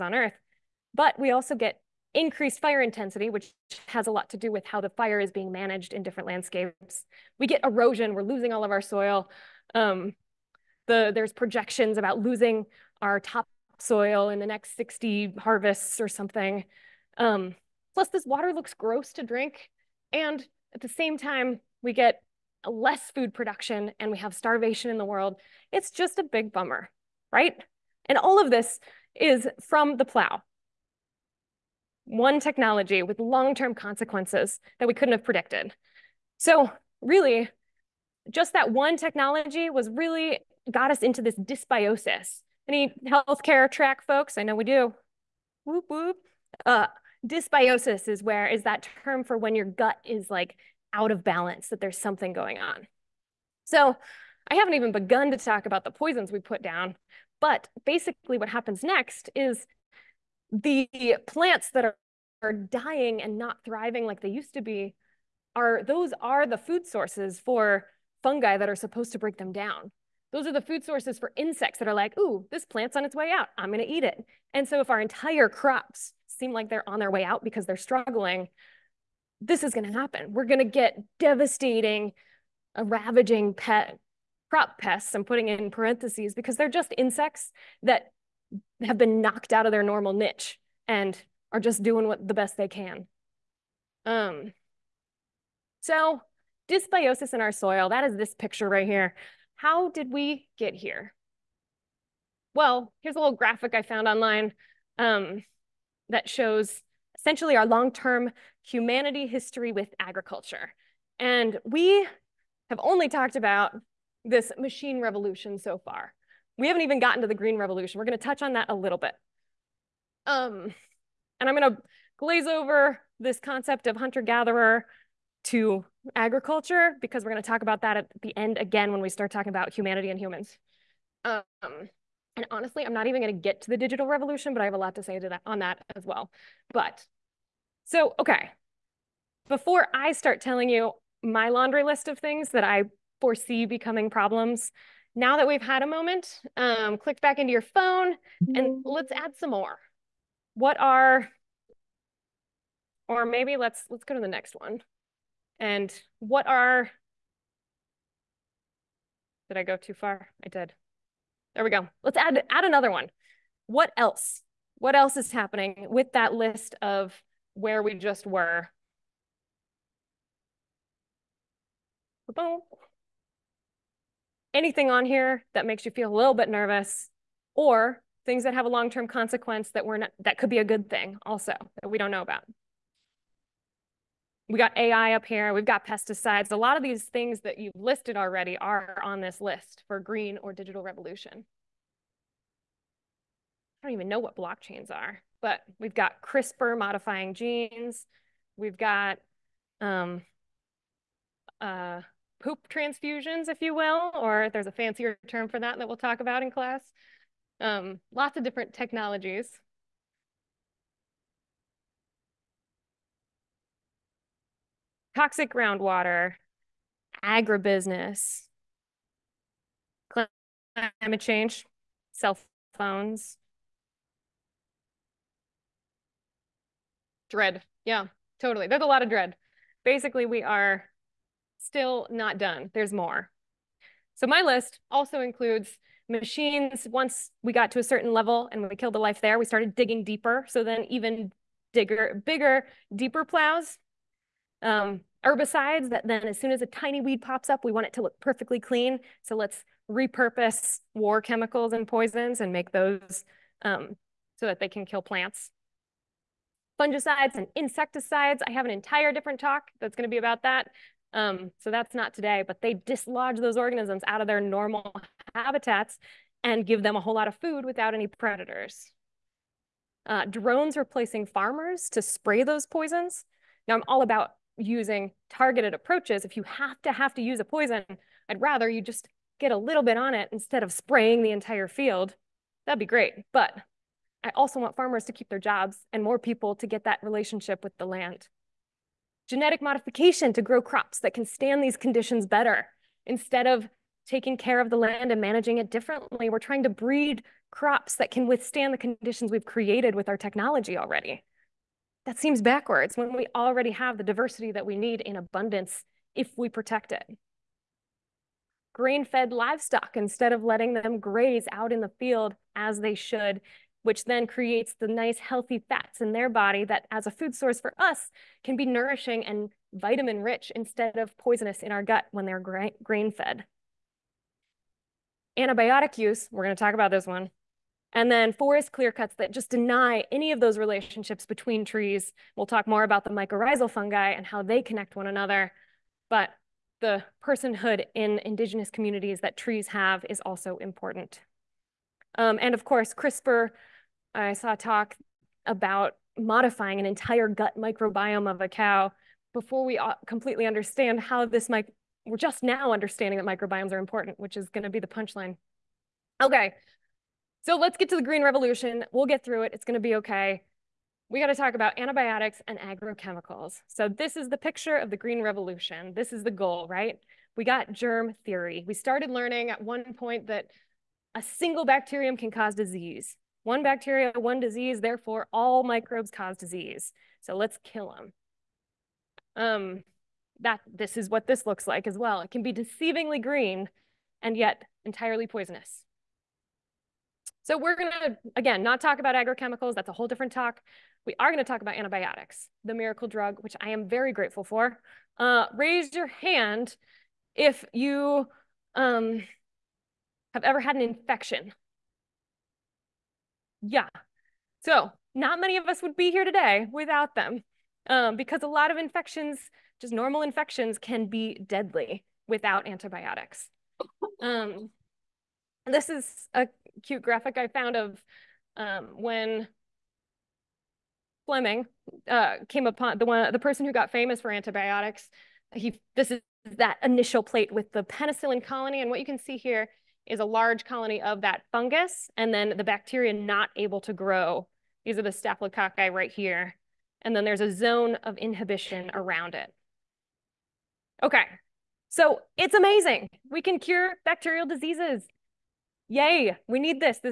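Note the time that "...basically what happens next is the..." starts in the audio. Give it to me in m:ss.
0:57.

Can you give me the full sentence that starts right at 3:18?
We've got um, uh, poop transfusions, if you will, or there's a fancier term for that that we'll talk about in class.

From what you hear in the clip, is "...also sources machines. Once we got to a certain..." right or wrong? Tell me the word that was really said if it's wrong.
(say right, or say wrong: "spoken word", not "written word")
wrong: "includes", not "sources".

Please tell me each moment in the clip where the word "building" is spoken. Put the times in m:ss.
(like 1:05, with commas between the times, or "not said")
not said.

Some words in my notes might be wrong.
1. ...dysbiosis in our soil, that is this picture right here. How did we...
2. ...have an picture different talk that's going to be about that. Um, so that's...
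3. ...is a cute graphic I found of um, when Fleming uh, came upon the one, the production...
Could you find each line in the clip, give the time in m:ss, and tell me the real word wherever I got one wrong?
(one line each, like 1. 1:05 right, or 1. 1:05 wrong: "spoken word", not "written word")
1. 1:36 right
2. 4:18 wrong: "entire", not "picture"
3. 6:55 wrong: "person", not "production".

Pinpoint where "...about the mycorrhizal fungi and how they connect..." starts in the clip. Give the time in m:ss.
5:32.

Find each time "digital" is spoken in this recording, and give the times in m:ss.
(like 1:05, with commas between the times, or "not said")
2:13, 3:10.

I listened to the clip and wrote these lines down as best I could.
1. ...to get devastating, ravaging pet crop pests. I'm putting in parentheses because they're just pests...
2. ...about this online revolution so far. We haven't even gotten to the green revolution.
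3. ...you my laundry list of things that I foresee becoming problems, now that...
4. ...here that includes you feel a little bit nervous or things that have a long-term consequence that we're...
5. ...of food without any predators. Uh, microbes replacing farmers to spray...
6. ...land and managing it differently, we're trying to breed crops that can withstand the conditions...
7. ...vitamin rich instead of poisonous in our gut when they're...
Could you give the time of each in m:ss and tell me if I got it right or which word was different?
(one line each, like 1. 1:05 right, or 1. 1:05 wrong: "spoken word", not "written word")
1. 1:20 wrong: "insects", not "pests"
2. 1:53 wrong: "machine", not "online"
3. 2:20 right
4. 2:55 wrong: "makes", not "includes"
5. 4:27 wrong: "drones", not "microbes"
6. 4:54 right
7. 5:19 right.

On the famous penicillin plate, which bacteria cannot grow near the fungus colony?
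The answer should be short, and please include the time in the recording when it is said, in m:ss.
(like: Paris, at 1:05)
staphylococci, at 7:15.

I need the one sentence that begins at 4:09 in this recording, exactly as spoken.
So let's repurpose war chemicals and poisons and make those um, so that they can kill plants.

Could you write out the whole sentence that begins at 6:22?
It can be deceivingly green and yet entirely poisonous.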